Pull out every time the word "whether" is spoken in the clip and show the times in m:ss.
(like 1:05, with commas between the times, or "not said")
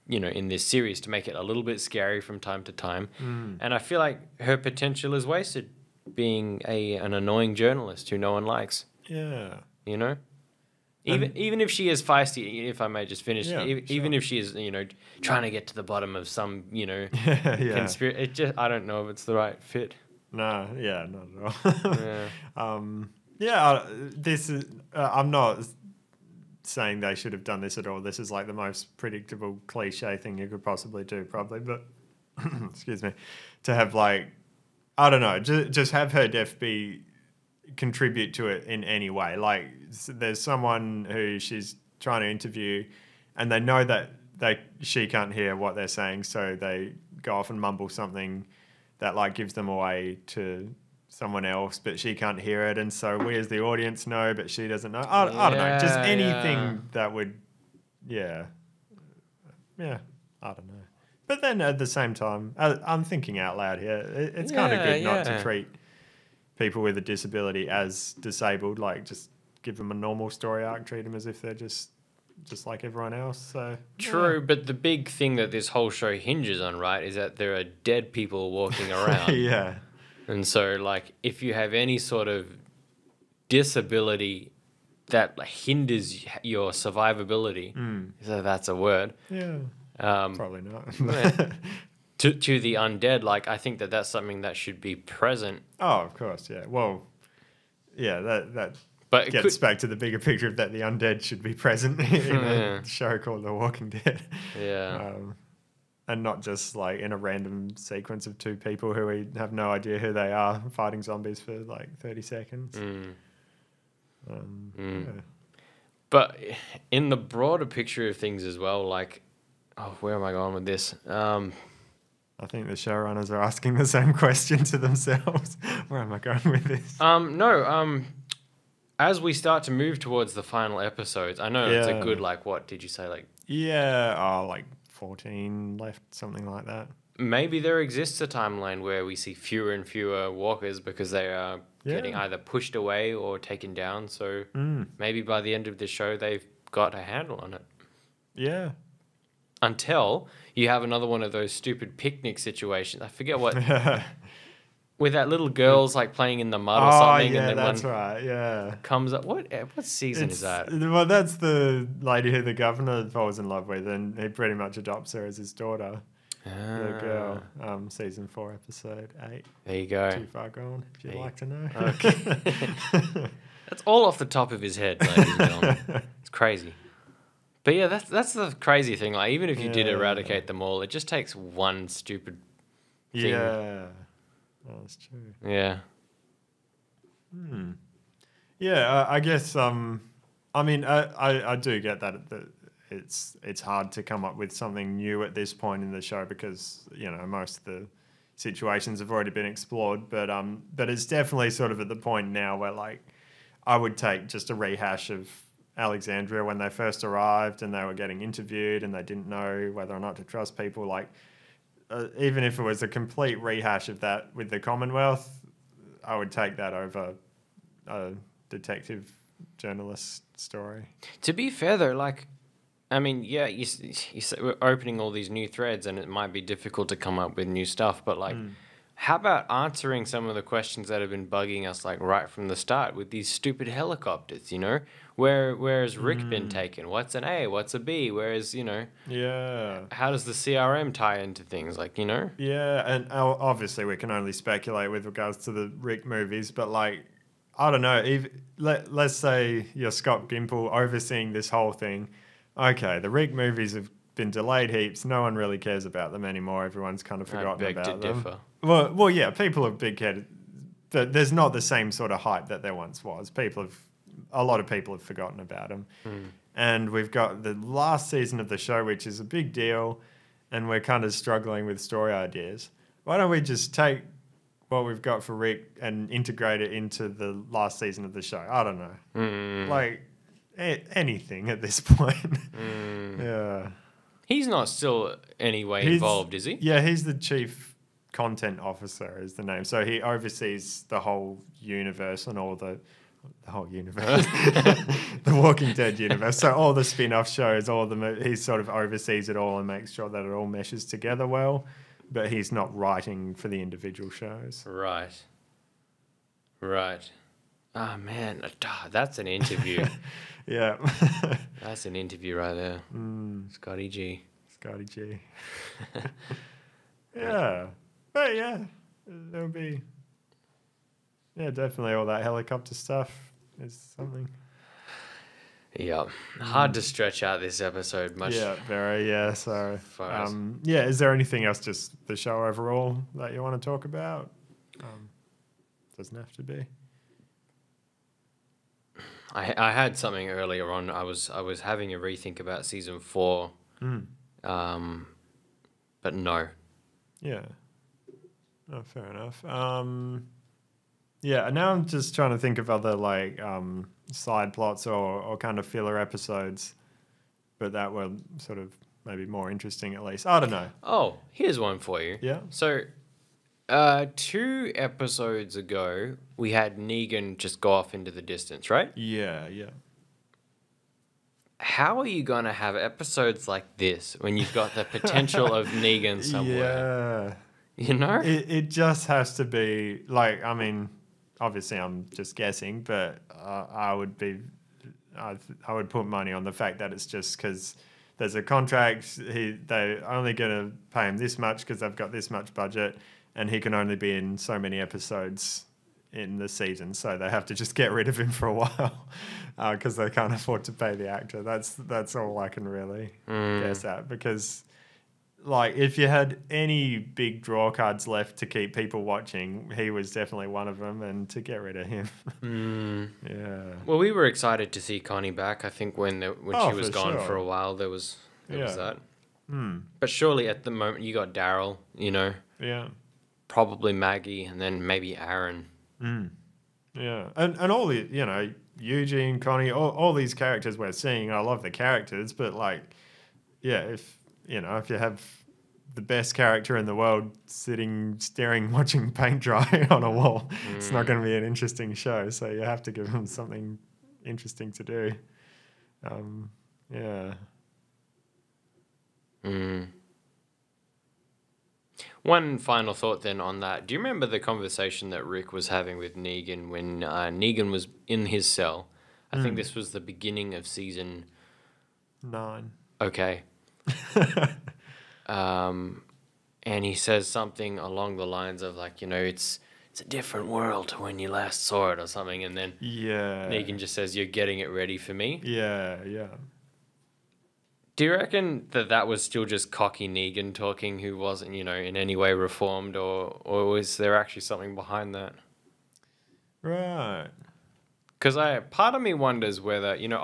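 3:29, 8:09.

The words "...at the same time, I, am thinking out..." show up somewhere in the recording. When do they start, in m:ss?
1:01.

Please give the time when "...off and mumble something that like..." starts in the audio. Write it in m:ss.
0:47.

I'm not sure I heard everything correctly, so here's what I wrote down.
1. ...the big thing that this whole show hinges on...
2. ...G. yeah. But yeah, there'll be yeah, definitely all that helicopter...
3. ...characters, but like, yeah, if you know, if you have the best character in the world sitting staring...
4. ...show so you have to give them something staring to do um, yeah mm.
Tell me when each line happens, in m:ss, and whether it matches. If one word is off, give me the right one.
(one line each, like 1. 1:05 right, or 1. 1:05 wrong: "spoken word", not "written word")
1. 1:14 right
2. 5:14 right
3. 7:11 right
4. 7:21 wrong: "interesting", not "staring".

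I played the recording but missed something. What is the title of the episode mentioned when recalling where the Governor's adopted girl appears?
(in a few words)
Too Far Gone.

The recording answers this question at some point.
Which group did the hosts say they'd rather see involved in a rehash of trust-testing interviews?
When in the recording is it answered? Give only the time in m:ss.
3:34.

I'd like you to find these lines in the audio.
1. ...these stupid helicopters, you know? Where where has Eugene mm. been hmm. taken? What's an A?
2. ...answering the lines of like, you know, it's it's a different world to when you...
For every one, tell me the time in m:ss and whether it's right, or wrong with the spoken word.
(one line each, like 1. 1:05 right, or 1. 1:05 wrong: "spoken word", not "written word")
1. 3:53 wrong: "Rick", not "Eugene"
2. 7:47 wrong: "along", not "answering".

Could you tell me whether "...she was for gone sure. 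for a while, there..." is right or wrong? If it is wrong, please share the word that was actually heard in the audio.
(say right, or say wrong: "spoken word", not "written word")
right.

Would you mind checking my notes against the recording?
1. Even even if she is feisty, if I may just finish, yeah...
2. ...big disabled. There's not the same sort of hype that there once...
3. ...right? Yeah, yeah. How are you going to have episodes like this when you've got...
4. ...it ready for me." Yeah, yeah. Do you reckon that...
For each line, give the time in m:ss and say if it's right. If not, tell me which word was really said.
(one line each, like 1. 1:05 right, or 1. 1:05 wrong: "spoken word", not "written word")
1. 0:11 right
2. 4:19 wrong: "headed", not "disabled"
3. 6:08 right
4. 7:54 right.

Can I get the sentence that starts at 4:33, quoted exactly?
Why don't we just take what we've got for Rick and integrate it into the last season of the show?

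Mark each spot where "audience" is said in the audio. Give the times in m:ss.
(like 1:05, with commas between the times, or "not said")
0:53.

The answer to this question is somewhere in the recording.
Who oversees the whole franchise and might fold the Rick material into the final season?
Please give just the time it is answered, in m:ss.
4:09.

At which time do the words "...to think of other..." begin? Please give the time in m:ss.
5:52.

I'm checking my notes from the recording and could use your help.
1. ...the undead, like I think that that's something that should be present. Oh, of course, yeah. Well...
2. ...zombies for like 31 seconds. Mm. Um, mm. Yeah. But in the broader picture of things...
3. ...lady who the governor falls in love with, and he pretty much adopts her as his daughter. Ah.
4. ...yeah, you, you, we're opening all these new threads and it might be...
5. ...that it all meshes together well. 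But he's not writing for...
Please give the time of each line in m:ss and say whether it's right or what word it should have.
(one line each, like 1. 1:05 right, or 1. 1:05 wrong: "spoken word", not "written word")
1. 1:32 right
2. 1:51 wrong: "30", not "31"
3. 2:42 right
4. 3:43 right
5. 5:00 right.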